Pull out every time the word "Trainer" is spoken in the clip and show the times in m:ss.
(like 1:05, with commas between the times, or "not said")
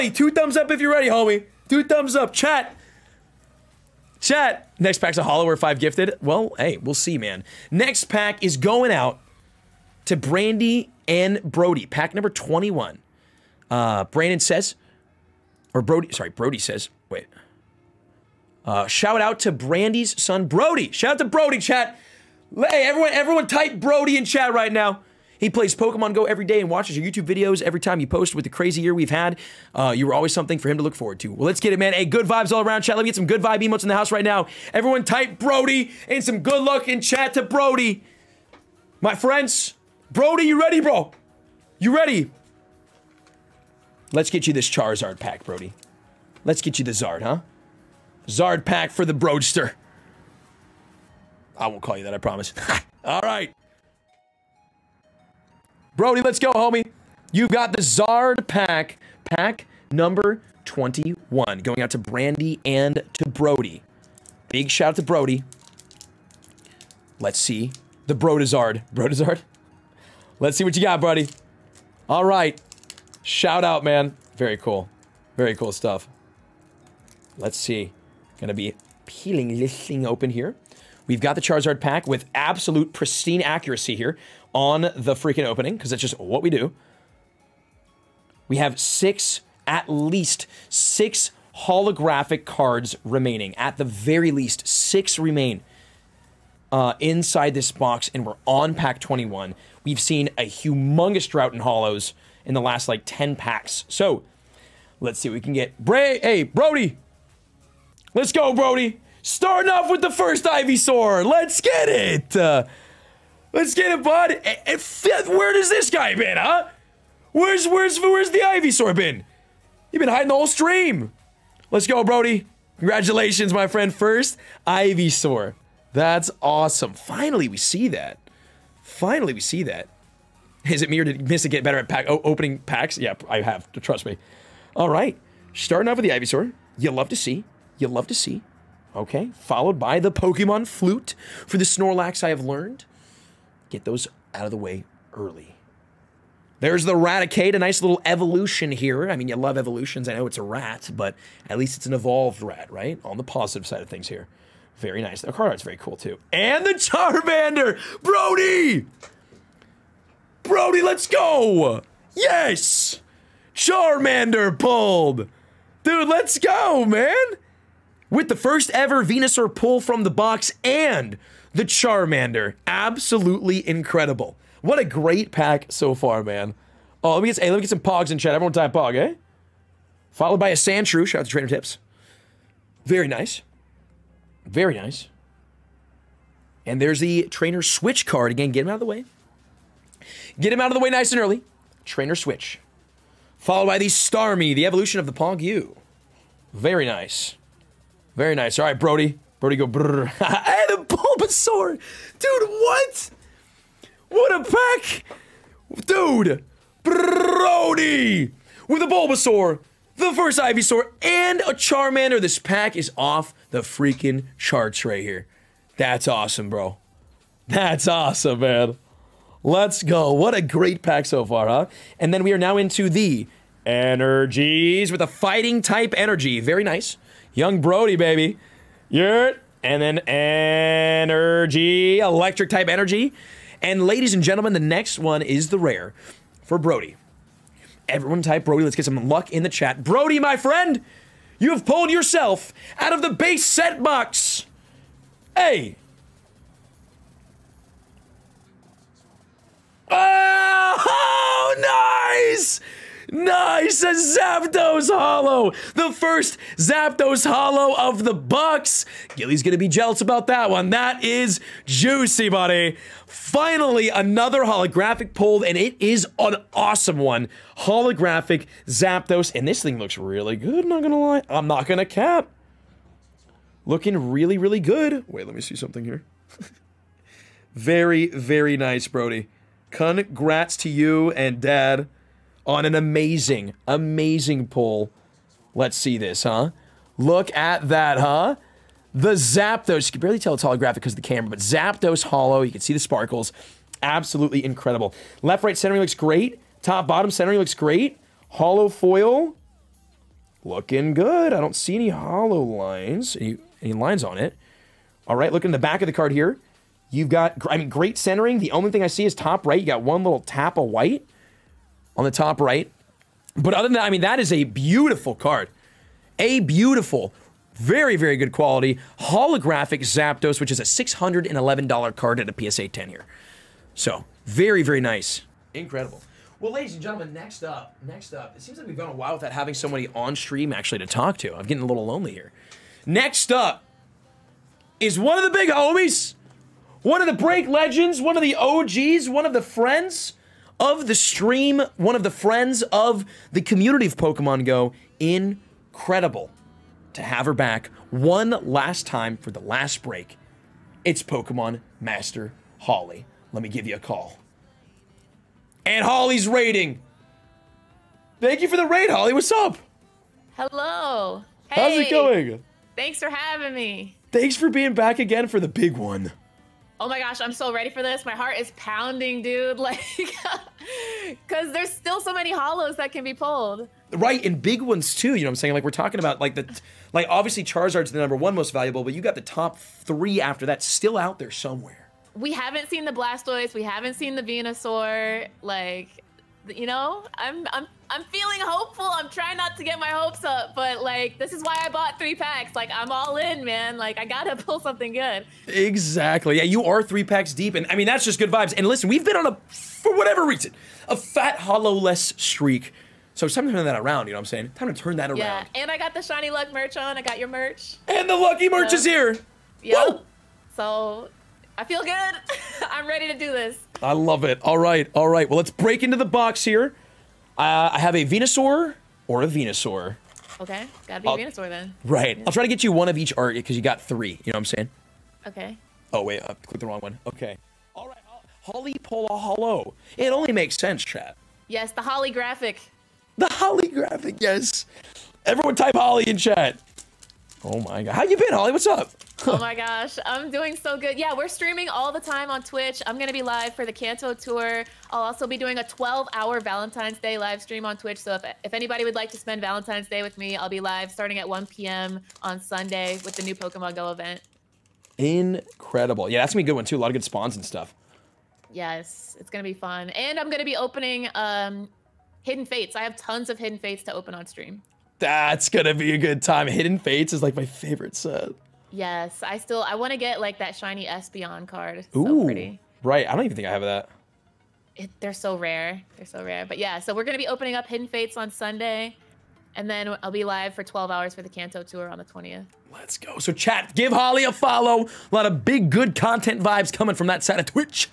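3:01, 3:07, 3:11.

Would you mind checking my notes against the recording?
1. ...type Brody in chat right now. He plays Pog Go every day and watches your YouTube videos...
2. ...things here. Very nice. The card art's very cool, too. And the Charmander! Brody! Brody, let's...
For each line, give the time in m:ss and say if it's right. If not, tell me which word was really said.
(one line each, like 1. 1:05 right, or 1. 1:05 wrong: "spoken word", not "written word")
1. 0:23 wrong: "Pokemon", not "Pog"
2. 2:33 right.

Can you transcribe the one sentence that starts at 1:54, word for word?
And, fifth, eh, eh, where does this guy been, huh?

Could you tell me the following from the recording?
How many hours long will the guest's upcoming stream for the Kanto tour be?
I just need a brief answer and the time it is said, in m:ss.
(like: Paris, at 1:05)
12, at 8:00.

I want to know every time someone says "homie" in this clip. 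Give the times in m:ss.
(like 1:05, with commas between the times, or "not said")
0:01, 0:56, 5:35.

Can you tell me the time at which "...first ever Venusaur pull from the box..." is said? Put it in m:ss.
2:48.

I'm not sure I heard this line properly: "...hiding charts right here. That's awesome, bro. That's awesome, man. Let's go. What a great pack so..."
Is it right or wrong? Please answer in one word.
wrong.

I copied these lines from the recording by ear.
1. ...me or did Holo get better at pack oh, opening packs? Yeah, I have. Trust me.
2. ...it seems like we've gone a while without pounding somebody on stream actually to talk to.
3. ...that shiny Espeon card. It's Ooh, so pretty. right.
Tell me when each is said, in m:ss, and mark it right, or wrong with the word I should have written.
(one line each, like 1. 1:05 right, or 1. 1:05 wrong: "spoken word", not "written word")
1. 2:10 wrong: "Missa", not "Holo"
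2. 5:28 wrong: "having", not "pounding"
3. 7:50 right.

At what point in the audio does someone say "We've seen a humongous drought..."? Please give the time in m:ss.
1:39.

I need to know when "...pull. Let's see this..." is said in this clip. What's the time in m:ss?
4:44.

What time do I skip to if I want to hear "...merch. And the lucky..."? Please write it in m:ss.
6:47.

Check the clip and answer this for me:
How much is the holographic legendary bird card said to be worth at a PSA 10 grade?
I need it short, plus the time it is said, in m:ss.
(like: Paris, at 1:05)
$611, at 5:20.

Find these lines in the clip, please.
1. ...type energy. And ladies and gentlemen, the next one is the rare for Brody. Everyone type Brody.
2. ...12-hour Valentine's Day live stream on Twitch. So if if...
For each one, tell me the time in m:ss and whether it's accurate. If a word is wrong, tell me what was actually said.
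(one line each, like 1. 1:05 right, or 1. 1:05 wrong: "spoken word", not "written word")
1. 3:52 right
2. 7:25 right.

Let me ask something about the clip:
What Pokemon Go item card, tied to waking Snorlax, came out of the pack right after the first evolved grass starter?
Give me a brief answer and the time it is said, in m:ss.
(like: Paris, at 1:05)
Pokemon Flute, at 2:20.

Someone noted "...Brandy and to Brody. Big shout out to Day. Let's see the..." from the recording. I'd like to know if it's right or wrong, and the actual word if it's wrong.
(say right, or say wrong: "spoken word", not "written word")
wrong: "Brody", not "Day".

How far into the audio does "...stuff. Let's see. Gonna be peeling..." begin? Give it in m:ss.
1:15.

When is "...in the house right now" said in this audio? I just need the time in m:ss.
0:33.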